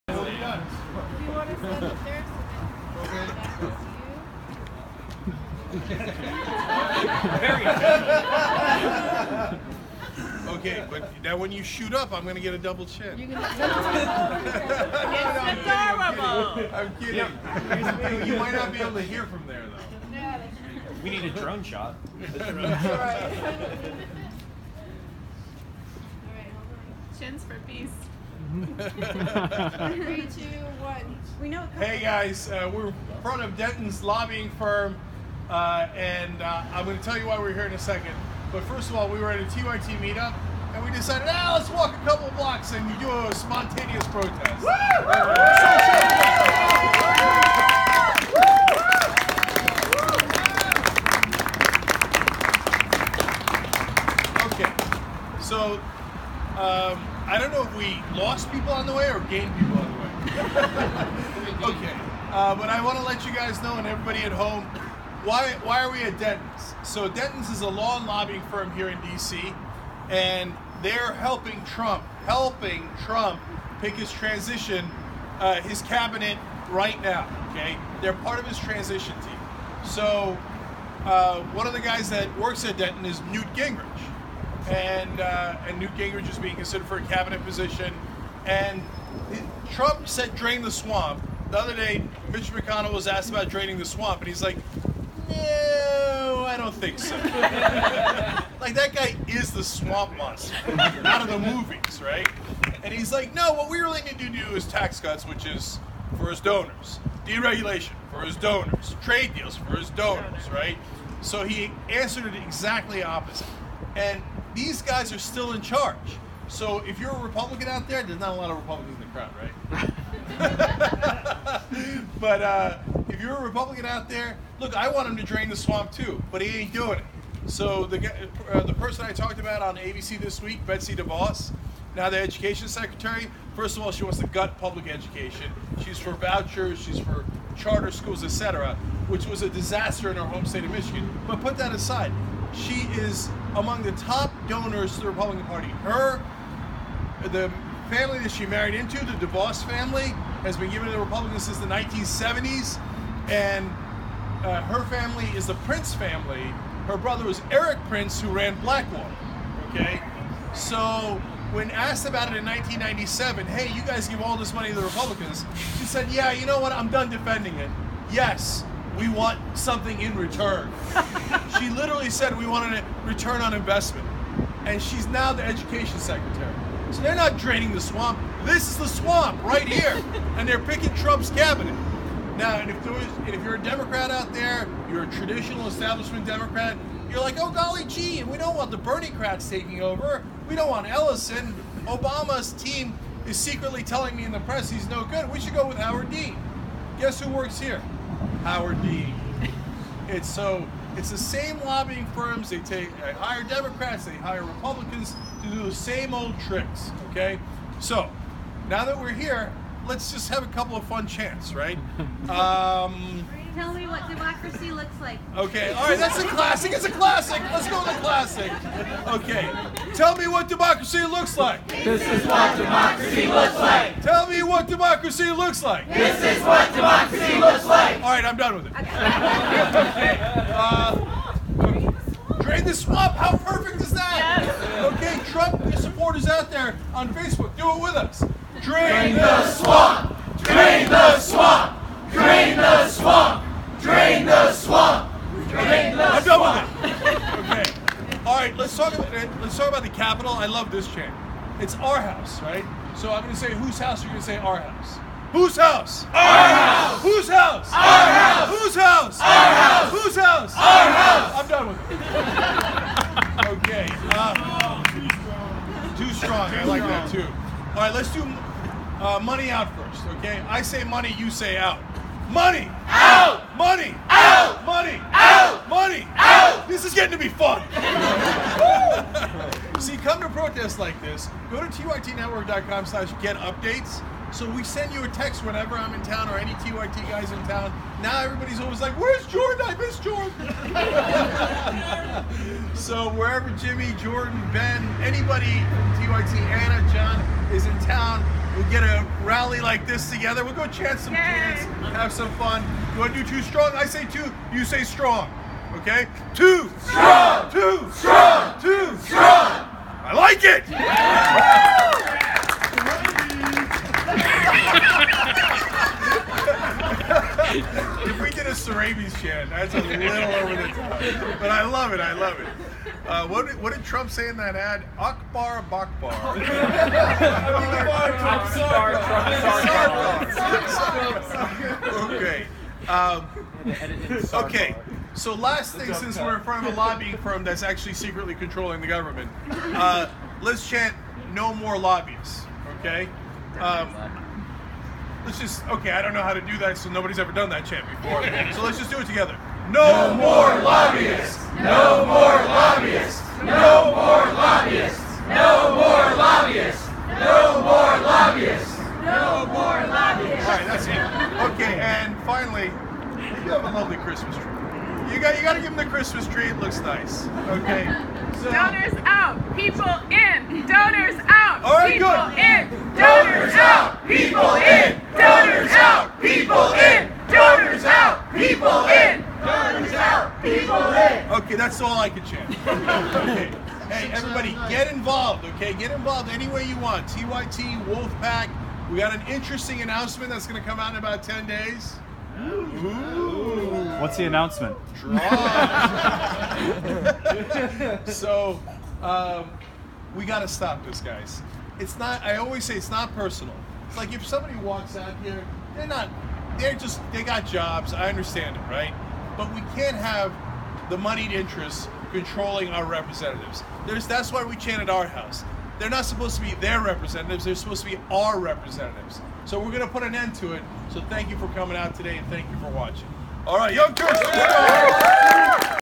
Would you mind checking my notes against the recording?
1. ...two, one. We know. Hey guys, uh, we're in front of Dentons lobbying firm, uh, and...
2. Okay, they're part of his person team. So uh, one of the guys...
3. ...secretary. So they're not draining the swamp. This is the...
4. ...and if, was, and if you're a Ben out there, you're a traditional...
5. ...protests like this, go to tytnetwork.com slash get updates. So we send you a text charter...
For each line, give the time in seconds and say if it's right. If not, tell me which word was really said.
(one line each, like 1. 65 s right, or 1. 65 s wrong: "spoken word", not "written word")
1. 30 s right
2. 77 s wrong: "transition", not "person"
3. 175 s right
4. 182 s wrong: "Democrat", not "Ben"
5. 280 s wrong: "whenever", not "charter".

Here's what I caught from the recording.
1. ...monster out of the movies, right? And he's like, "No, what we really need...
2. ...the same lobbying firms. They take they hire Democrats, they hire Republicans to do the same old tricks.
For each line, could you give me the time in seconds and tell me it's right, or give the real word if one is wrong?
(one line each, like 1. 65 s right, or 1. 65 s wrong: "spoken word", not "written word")
1. 100 s right
2. 201 s right.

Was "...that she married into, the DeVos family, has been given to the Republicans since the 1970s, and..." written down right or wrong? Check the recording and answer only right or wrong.
right.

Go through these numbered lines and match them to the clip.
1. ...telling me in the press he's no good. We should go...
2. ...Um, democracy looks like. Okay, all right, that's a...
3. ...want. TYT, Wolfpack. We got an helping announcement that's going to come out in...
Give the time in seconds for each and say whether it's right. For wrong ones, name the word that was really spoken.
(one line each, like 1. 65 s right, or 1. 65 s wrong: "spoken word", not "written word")
1. 193 s right
2. 212 s right
3. 386 s wrong: "interesting", not "helping".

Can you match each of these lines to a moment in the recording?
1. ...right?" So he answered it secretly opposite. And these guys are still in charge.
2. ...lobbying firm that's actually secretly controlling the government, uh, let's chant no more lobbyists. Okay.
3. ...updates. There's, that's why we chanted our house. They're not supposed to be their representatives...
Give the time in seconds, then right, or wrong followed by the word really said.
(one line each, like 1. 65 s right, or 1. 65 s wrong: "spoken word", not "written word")
1. 110 s wrong: "exactly", not "secretly"
2. 336 s right
3. 412 s wrong: "representatives", not "updates".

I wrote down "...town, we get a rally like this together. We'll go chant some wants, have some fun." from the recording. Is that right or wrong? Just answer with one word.
wrong.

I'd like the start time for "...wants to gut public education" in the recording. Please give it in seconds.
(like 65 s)
134 s.